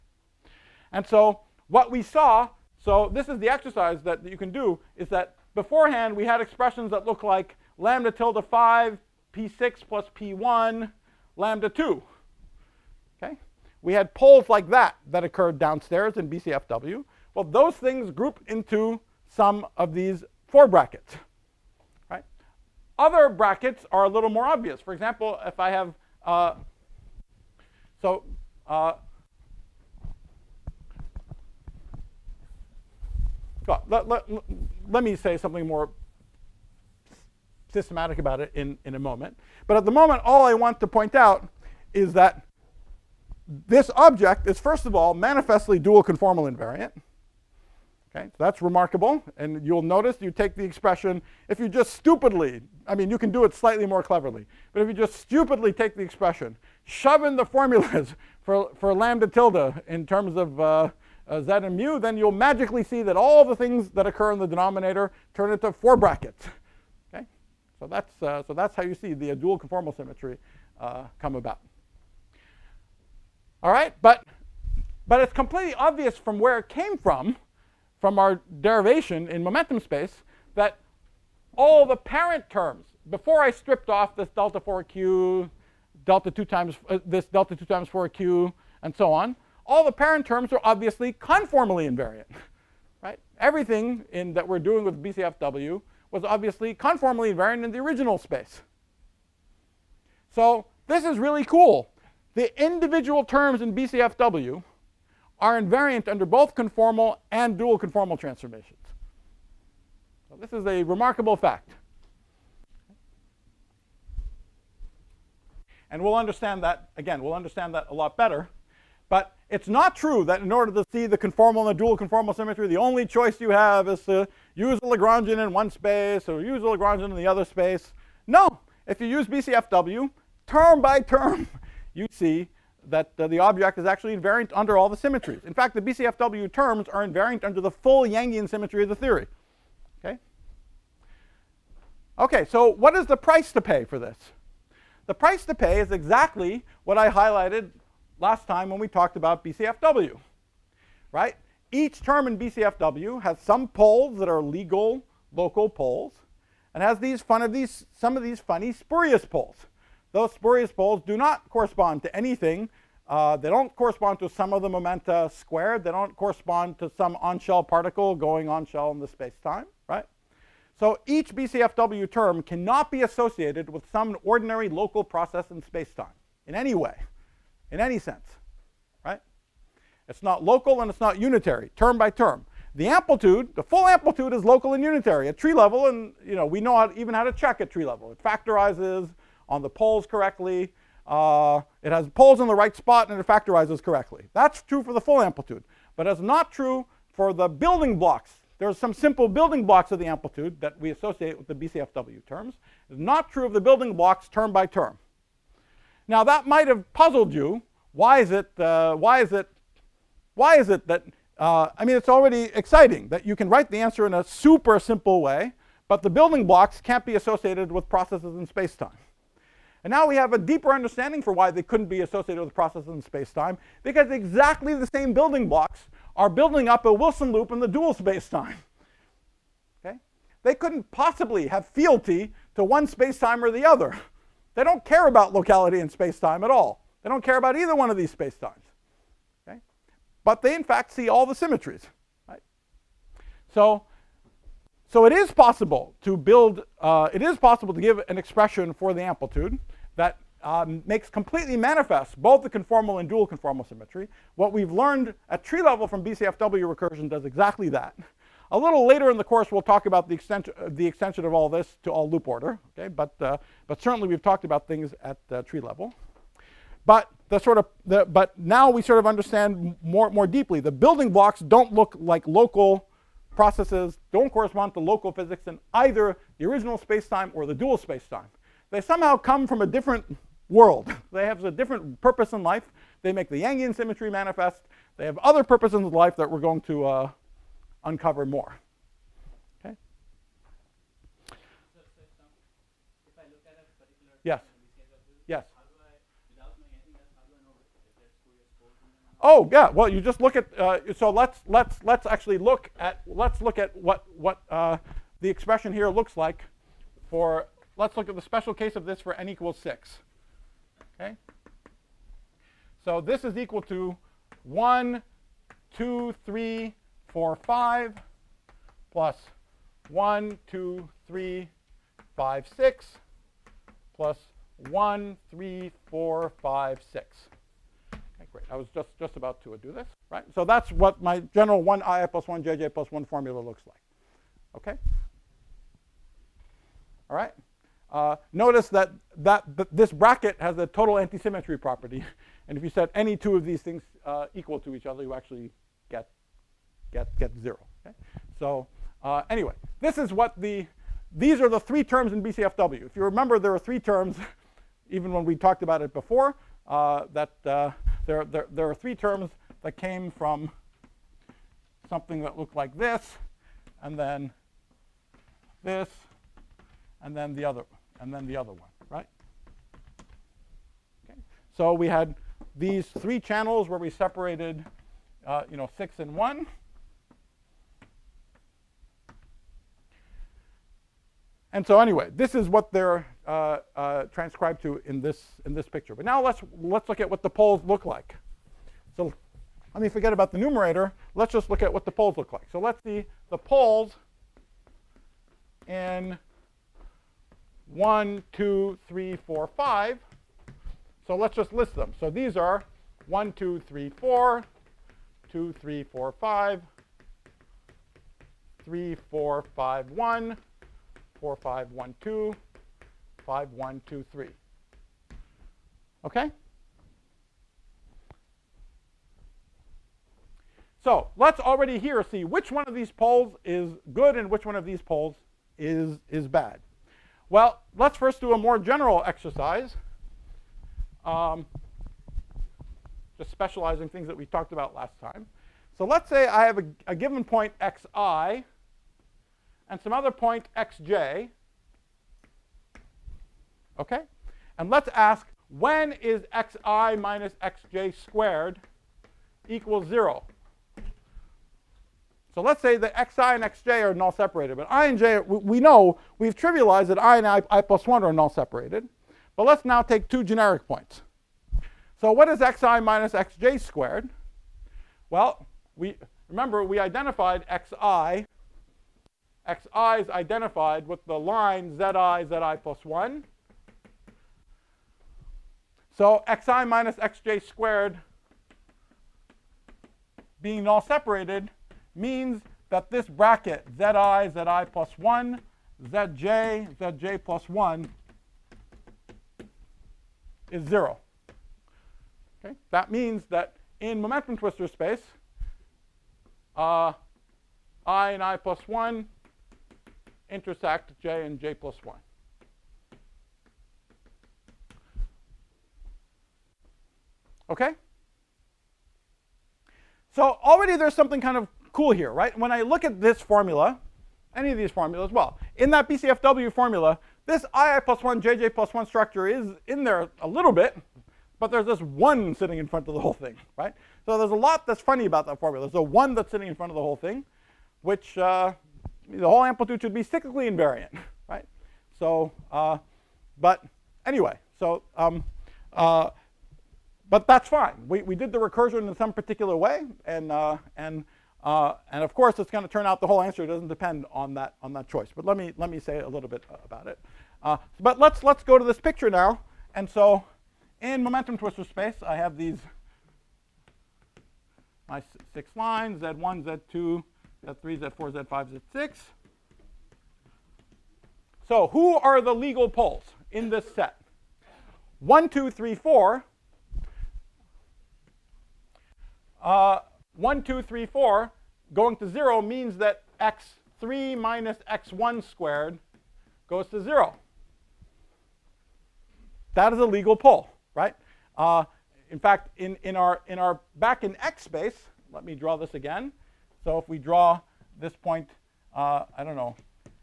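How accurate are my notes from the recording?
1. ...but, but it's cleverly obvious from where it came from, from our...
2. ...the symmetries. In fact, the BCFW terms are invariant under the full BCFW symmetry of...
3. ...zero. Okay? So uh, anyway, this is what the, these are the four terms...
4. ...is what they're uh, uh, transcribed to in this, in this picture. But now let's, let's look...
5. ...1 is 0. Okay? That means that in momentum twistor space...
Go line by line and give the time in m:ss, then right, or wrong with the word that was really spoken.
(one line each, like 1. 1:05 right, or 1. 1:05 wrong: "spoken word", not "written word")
1. 1:14 wrong: "completely", not "cleverly"
2. 2:14 wrong: "Yangian", not "BCFW"
3. 5:47 wrong: "three", not "four"
4. 6:22 right
5. 8:07 right.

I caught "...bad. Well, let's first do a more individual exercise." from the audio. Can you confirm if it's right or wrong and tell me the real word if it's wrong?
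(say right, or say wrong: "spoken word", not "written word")
wrong: "general", not "individual".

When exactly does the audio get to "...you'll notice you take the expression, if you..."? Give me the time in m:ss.
0:49.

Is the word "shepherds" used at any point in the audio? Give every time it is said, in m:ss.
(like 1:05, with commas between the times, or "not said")
not said.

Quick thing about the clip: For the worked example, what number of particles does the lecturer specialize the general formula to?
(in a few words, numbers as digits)
6.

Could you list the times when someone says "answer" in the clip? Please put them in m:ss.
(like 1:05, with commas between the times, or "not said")
3:33, 9:03.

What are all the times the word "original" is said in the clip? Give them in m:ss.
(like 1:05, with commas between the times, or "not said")
1:37, 4:36.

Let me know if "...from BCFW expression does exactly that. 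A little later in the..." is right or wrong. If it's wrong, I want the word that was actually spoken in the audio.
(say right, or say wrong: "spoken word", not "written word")
wrong: "recursion", not "expression".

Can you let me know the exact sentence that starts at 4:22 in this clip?
But, uh, but certainly we've talked about things at uh, tree level.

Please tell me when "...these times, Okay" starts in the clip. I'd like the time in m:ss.
3:57.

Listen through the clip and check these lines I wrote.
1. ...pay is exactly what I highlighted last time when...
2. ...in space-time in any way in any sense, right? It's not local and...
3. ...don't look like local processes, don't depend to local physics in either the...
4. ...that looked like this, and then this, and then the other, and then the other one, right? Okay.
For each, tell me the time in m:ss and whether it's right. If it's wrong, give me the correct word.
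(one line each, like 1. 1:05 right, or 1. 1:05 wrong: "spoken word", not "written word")
1. 2:25 right
2. 2:55 right
3. 4:31 wrong: "correspond", not "depend"
4. 6:02 right.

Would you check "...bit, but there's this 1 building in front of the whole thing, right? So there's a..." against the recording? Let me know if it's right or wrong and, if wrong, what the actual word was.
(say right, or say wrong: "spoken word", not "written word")
wrong: "sitting", not "building".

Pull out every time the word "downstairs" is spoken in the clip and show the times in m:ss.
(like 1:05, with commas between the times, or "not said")
0:15.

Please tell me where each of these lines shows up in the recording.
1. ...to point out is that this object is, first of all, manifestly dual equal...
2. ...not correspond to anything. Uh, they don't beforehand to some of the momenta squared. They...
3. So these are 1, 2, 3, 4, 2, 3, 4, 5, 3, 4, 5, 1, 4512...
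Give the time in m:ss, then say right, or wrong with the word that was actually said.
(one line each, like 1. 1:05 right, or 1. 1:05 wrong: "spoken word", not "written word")
1. 0:40 wrong: "conformal", not "equal"
2. 2:41 wrong: "correspond", not "beforehand"
3. 6:41 right.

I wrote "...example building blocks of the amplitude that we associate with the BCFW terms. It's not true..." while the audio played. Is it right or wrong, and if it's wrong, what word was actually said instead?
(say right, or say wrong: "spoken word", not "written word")
wrong: "simple", not "example".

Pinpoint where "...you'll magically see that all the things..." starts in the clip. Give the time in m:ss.
1:02.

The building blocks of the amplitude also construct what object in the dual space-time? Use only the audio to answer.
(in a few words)
a Wilson loop.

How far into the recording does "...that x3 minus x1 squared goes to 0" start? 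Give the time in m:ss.
9:32.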